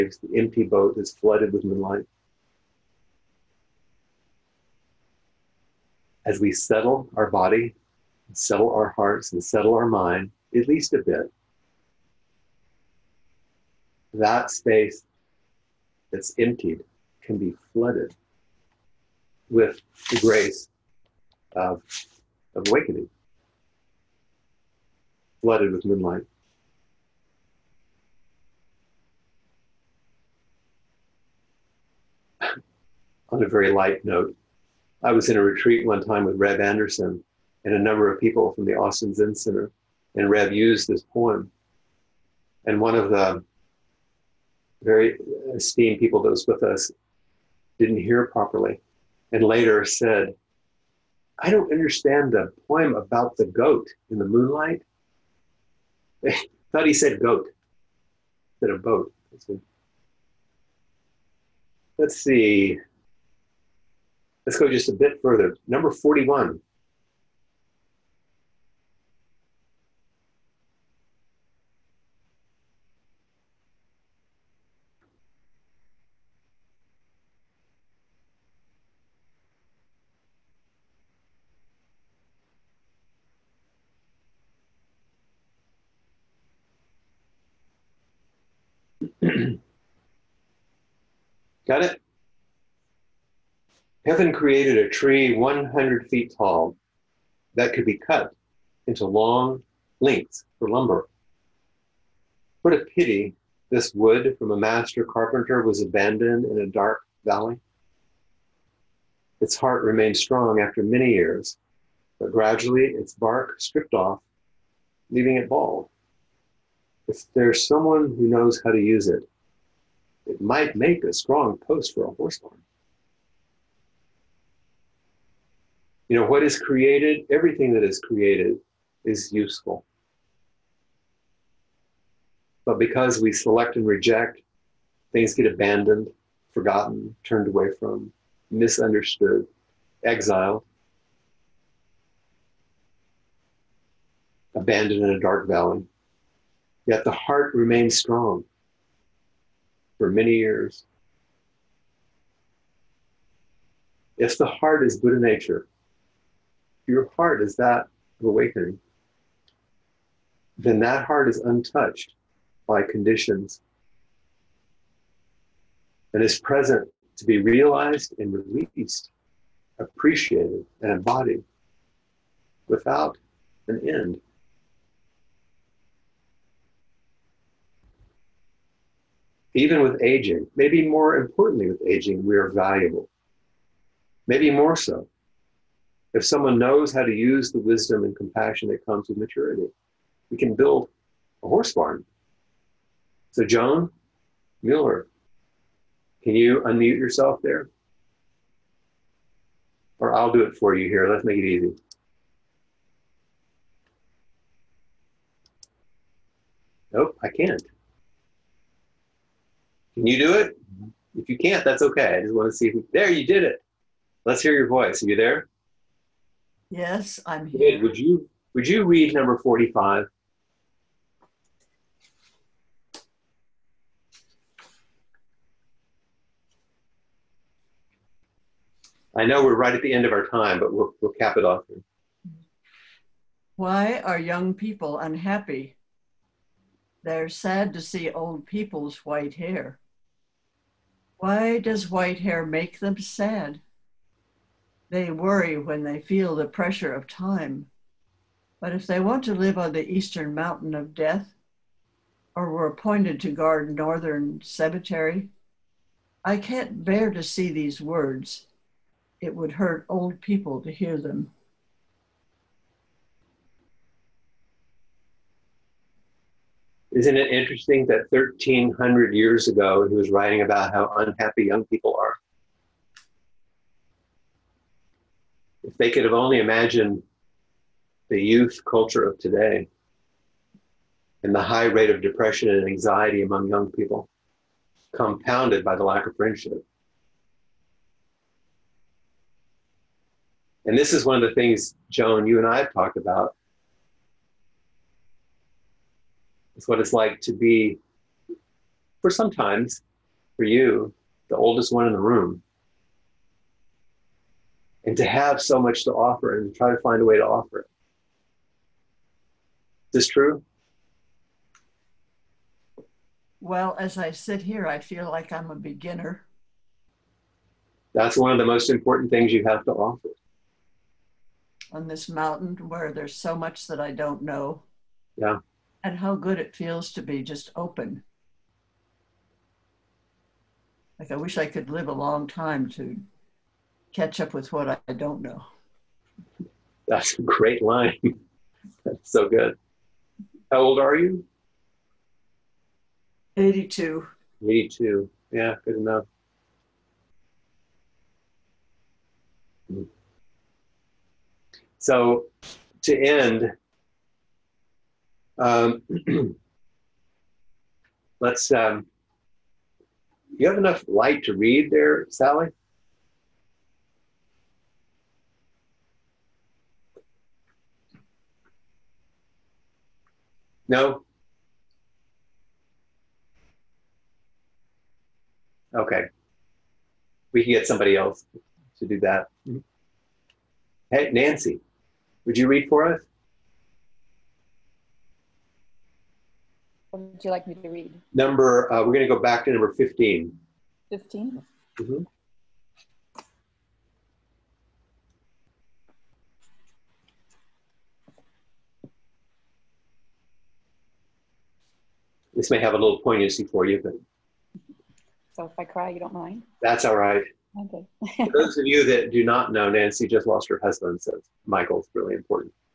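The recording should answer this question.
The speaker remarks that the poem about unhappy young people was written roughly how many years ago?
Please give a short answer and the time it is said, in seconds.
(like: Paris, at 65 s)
1,300, at 268 s.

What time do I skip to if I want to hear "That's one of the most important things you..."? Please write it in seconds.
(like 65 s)
317 s.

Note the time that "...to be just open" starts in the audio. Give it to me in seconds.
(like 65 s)
326 s.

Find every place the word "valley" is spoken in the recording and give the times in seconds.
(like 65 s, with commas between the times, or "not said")
107 s, 145 s.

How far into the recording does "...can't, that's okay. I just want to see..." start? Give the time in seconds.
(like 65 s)
211 s.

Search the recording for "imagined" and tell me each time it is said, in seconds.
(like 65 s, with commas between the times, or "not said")
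276 s.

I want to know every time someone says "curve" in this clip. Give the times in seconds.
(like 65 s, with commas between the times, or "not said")
not said.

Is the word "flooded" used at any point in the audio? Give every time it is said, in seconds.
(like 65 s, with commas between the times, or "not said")
1 s, 17 s, 25 s.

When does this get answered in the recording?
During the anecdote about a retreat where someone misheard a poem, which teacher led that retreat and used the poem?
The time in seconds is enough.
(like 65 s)
36 s.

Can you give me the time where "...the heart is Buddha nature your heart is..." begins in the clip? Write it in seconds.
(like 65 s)
154 s.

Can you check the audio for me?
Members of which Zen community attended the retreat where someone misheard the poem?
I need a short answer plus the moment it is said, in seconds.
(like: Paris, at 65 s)
Austin Zen Center, at 38 s.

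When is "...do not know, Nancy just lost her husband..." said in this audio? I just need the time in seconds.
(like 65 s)
409 s.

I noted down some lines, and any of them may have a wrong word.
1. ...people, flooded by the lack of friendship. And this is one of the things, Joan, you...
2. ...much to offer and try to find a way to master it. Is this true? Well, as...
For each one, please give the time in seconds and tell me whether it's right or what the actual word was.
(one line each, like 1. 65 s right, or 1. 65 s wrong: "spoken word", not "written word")
1. 283 s wrong: "compounded", not "flooded"
2. 305 s wrong: "offer", not "master".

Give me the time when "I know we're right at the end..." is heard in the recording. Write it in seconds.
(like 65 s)
229 s.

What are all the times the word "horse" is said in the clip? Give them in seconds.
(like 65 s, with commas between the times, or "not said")
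122 s, 191 s.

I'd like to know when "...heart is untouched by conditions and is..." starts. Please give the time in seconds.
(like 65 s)
161 s.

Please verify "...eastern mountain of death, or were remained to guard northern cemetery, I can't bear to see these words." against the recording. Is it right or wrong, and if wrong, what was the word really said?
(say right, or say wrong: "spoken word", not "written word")
wrong: "appointed", not "remained".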